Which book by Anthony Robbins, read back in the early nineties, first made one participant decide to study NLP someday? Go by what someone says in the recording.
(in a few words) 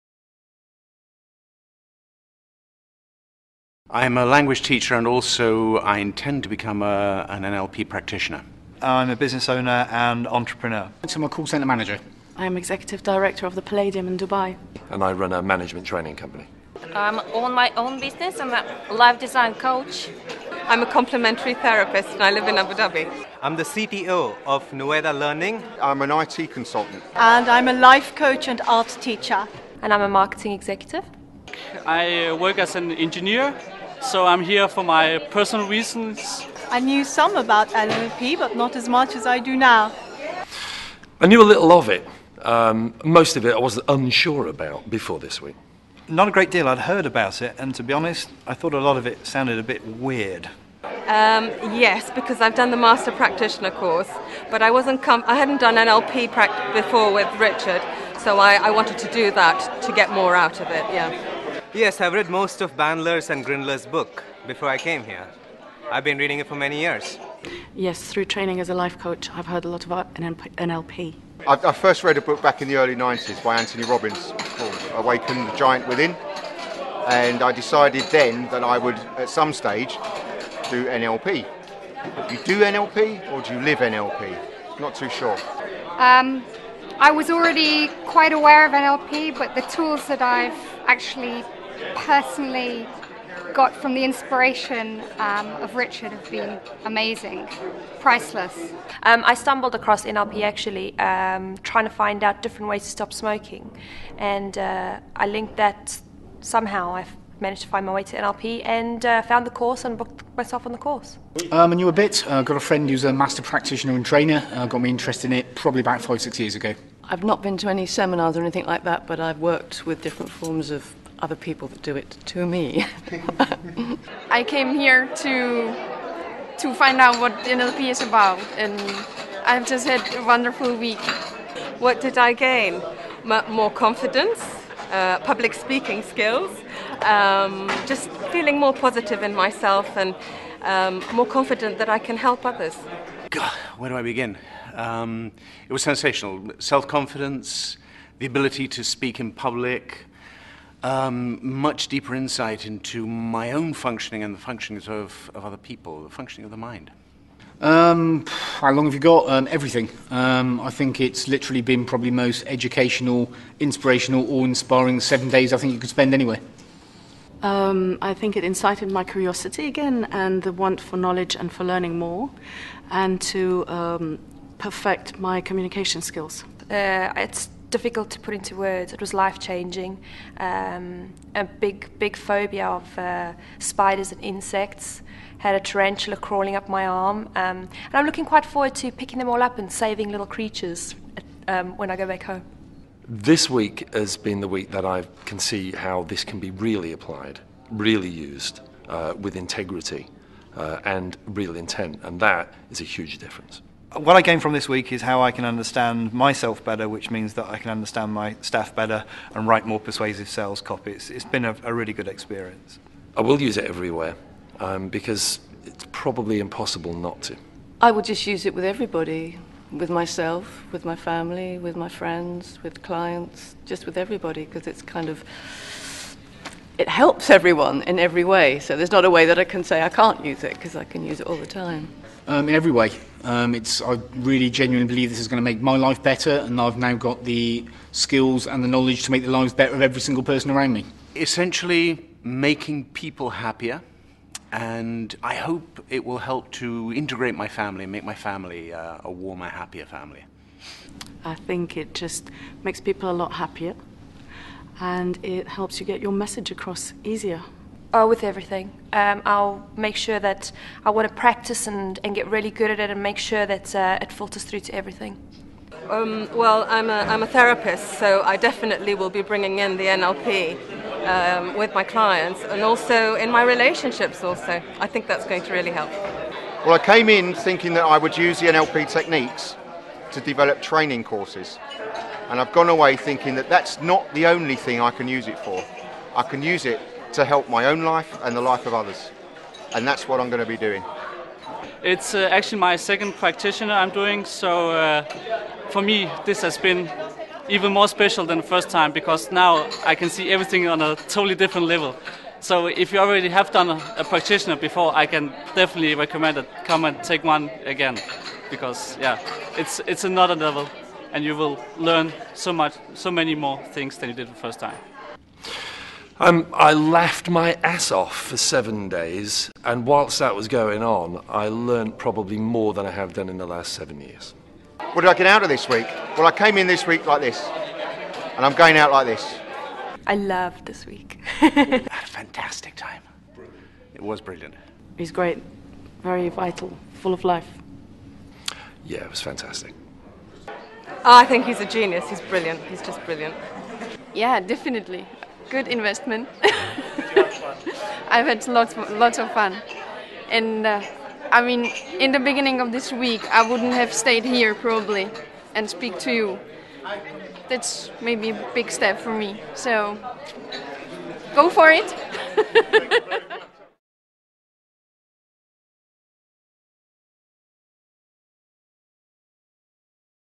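Awaken the Giant Within.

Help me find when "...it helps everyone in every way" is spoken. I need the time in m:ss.
3:46.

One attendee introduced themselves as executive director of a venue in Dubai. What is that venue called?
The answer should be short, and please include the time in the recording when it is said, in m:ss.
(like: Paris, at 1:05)
Palladium, at 0:13.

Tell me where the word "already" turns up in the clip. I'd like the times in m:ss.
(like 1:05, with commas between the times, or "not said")
1:27, 5:02.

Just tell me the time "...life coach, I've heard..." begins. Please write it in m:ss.
1:08.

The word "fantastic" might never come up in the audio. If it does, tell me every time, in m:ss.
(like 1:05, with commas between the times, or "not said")
5:32, 5:39.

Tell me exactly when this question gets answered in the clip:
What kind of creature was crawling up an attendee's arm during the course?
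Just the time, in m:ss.
3:05.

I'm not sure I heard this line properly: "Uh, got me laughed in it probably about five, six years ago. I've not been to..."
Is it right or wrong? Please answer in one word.
wrong.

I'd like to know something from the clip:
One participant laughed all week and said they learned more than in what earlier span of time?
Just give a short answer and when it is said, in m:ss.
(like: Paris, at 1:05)
The last 7 years, at 5:23.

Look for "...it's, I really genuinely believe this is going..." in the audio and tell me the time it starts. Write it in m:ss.
3:53.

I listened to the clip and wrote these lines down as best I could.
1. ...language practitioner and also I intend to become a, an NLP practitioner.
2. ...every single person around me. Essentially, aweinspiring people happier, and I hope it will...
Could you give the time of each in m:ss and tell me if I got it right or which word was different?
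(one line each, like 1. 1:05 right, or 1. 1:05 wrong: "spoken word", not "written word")
1. 0:04 wrong: "teacher", not "practitioner"
2. 3:59 wrong: "making", not "aweinspiring".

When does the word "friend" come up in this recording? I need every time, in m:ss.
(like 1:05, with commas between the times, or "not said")
1:52, 3:41.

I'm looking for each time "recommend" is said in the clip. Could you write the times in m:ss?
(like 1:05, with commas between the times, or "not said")
5:05.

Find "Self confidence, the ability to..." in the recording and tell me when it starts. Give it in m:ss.
2:26.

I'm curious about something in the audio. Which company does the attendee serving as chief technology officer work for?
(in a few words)
Nueda Learning.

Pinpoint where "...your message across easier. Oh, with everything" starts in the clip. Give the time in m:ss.
4:16.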